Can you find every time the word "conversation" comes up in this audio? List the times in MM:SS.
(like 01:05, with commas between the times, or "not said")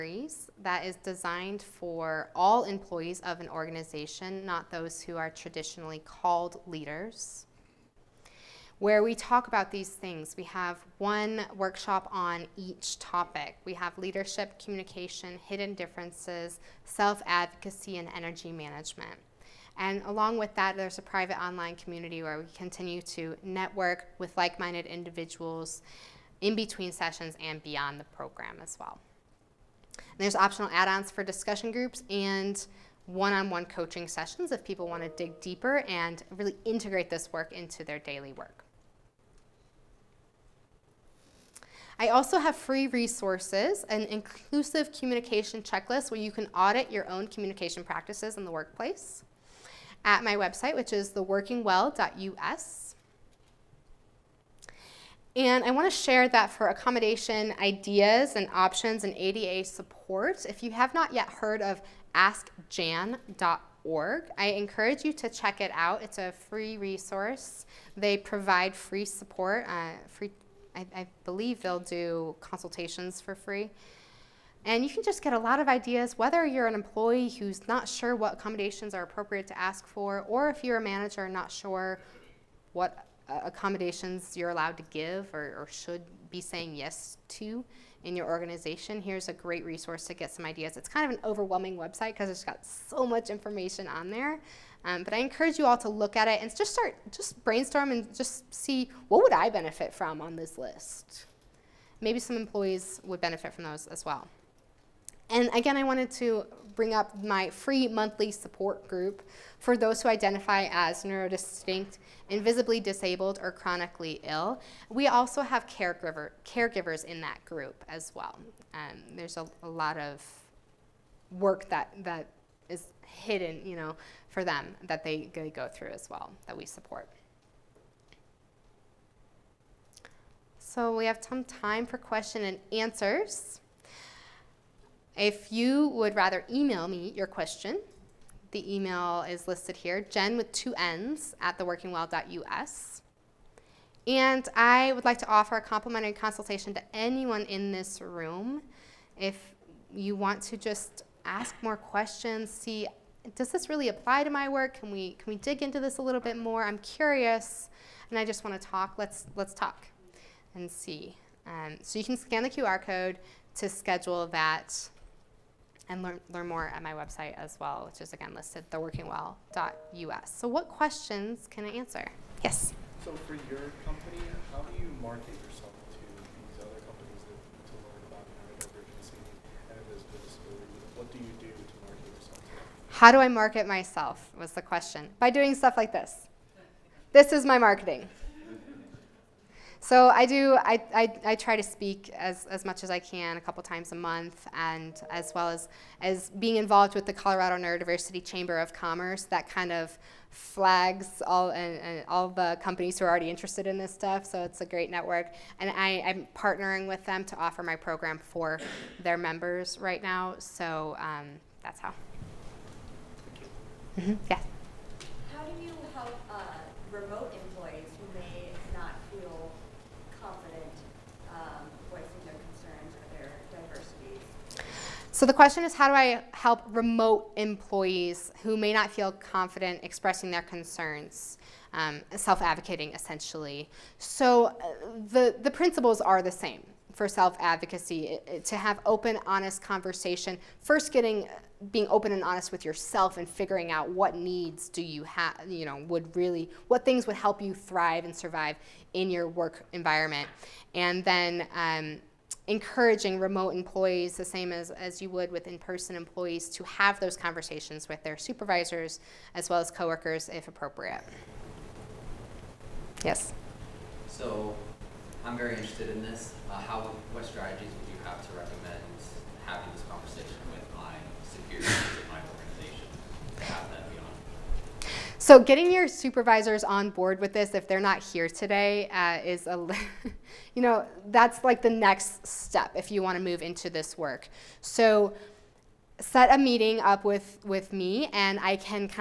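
03:59, 04:17, 04:29.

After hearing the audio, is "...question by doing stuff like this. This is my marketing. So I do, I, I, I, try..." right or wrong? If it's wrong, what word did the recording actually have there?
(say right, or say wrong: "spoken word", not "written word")
right.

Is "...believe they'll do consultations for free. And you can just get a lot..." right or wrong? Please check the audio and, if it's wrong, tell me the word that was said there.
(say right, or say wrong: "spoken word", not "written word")
right.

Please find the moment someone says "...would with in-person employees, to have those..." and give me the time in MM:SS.
04:15.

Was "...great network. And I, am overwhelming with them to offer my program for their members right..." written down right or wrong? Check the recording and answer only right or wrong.
wrong.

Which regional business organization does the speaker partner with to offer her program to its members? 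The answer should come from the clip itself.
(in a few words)
Colorado Neurodiversity Chamber of Commerce.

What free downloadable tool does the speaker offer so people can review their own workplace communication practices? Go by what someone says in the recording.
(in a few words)
Inclusive communication checklist.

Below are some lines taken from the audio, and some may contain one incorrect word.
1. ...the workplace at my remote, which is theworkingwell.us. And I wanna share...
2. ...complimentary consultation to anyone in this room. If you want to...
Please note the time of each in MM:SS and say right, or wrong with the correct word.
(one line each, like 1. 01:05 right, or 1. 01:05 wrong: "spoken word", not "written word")
1. 00:48 wrong: "website", not "remote"
2. 02:25 right.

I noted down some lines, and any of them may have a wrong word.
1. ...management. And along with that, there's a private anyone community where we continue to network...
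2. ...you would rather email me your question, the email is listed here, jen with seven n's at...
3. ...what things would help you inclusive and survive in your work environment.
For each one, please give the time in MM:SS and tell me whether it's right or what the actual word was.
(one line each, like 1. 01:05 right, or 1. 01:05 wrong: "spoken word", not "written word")
1. 00:18 wrong: "online", not "anyone"
2. 02:15 wrong: "two", not "seven"
3. 04:06 wrong: "thrive", not "inclusive".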